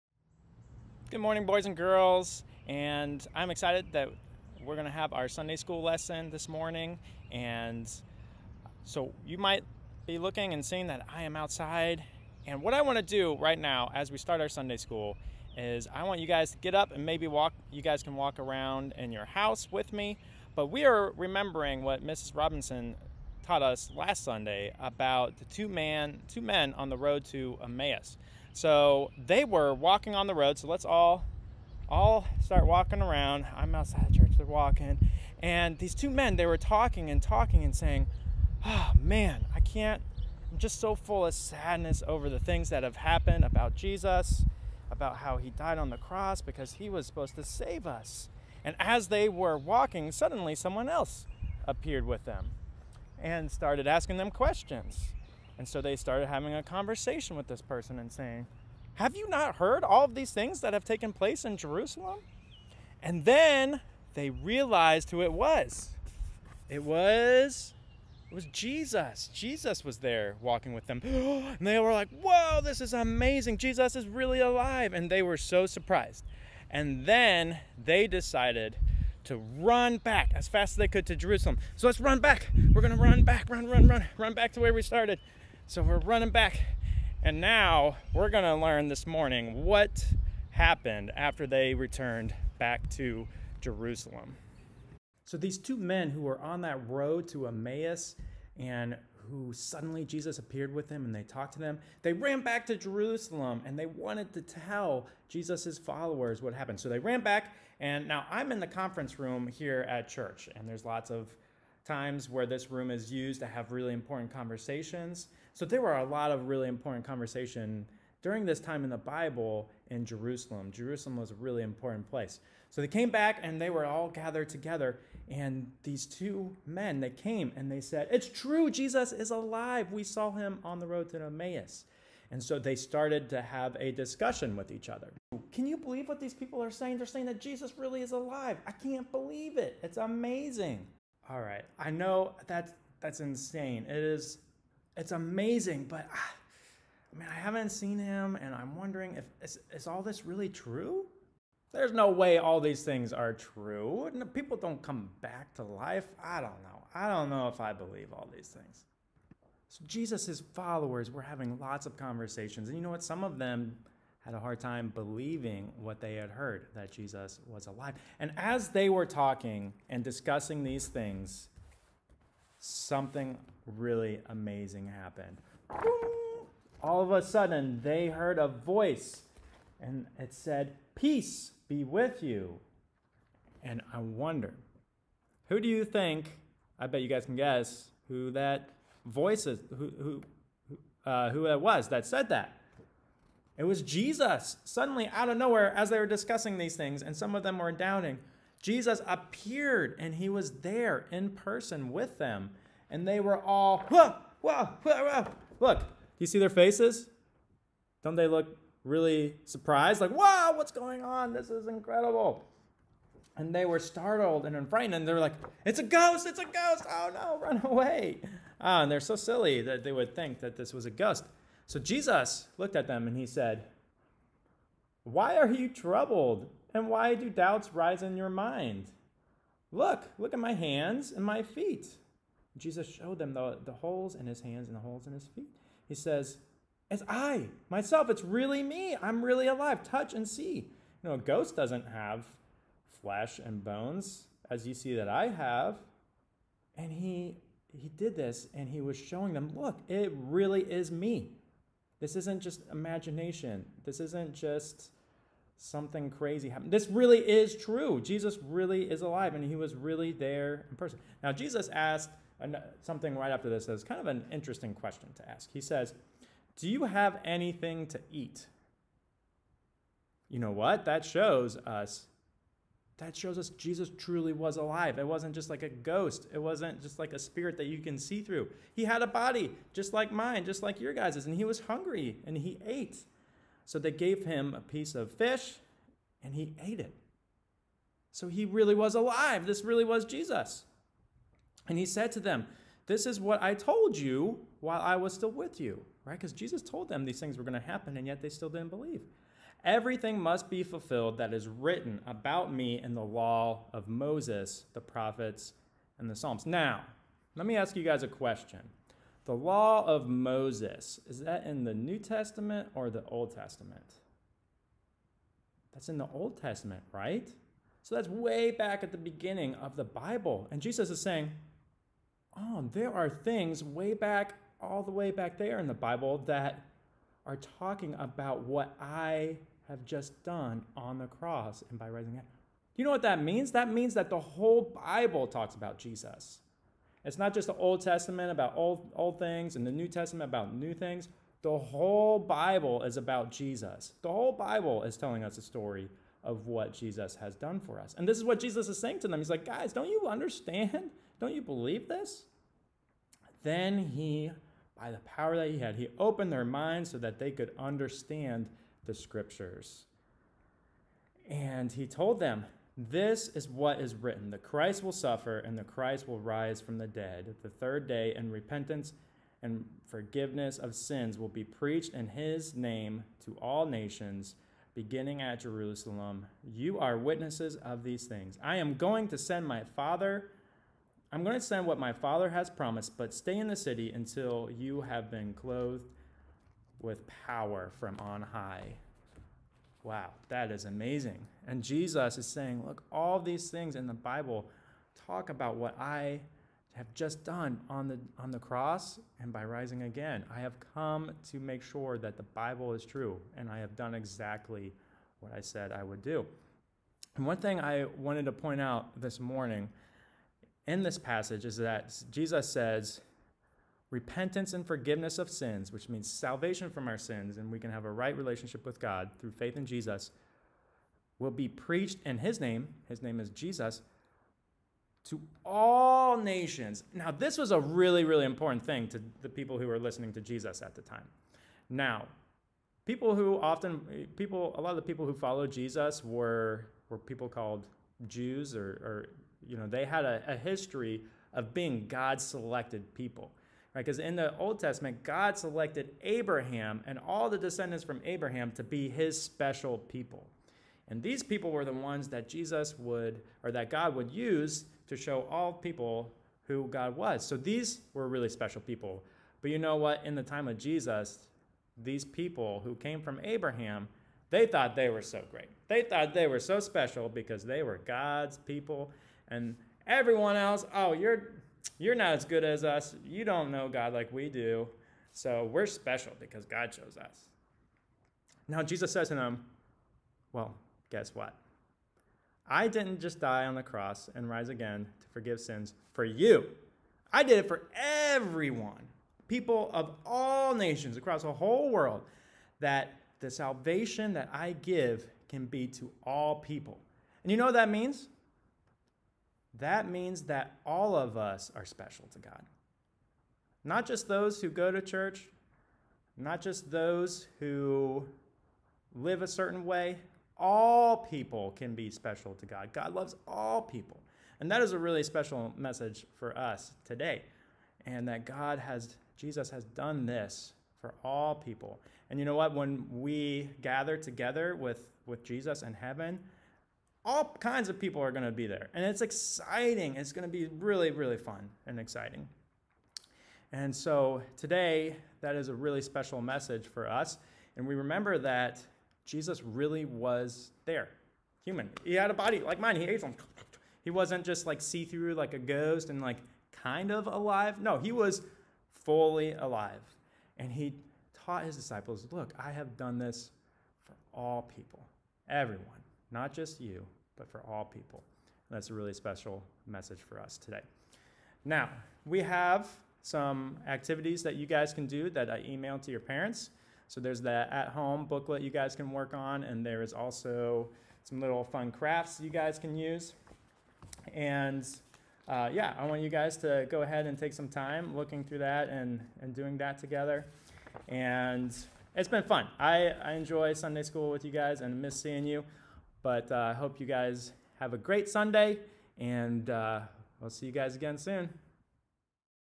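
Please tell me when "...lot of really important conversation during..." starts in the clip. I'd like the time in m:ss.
1:56.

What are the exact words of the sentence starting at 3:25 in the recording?
Look, do you see their faces?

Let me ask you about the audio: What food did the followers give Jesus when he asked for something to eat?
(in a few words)
a piece of fish.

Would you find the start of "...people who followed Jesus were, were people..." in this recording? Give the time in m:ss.
7:14.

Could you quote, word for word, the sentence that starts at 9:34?
And uh, yeah, I want you guys to go ahead and take some time looking through that and, and doing that together.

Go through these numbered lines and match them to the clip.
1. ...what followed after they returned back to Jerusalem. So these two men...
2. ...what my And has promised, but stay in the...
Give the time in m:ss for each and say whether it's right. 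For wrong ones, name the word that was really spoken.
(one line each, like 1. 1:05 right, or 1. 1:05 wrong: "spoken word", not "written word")
1. 1:29 wrong: "happened", not "followed"
2. 6:21 wrong: "Father", not "And".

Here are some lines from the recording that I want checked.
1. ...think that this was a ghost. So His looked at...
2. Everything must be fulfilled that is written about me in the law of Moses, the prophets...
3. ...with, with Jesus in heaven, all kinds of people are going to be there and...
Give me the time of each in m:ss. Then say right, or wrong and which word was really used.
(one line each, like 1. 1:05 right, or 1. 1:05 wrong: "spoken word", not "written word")
1. 3:40 wrong: "Jesus", not "His"
2. 4:59 right
3. 8:44 right.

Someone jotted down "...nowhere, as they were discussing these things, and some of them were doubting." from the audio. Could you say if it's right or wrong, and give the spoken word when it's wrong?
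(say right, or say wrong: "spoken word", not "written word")
right.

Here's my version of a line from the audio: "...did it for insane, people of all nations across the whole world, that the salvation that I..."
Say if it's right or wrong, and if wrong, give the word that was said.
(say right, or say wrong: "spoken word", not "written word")
wrong: "everyone", not "insane".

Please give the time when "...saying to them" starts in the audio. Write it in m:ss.
5:48.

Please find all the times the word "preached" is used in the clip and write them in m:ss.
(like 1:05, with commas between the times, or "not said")
6:11, 7:01.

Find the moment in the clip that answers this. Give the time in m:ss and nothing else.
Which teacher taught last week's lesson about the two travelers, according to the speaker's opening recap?
0:22.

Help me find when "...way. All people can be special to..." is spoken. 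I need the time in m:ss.
8:29.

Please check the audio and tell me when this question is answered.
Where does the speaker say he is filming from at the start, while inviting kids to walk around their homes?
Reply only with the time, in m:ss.
0:33.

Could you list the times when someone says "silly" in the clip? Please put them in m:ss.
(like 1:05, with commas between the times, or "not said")
3:39.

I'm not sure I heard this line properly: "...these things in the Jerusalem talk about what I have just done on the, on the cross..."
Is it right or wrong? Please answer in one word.
wrong.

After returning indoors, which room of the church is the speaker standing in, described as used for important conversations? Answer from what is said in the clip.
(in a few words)
the conference room.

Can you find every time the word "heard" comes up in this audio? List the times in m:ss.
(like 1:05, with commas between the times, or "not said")
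0:59, 2:46, 2:58.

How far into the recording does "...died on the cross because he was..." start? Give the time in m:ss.
0:45.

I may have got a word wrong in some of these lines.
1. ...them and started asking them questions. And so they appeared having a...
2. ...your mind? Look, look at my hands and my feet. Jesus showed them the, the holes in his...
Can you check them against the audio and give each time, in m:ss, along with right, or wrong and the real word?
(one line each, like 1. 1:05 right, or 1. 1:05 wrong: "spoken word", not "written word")
1. 0:52 wrong: "started", not "appeared"
2. 3:48 right.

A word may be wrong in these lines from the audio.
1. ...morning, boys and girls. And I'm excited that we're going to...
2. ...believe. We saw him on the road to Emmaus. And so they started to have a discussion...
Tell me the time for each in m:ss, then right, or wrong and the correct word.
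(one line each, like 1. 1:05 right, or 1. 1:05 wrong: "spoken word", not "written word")
1. 0:01 right
2. 2:09 wrong: "alive", not "believe".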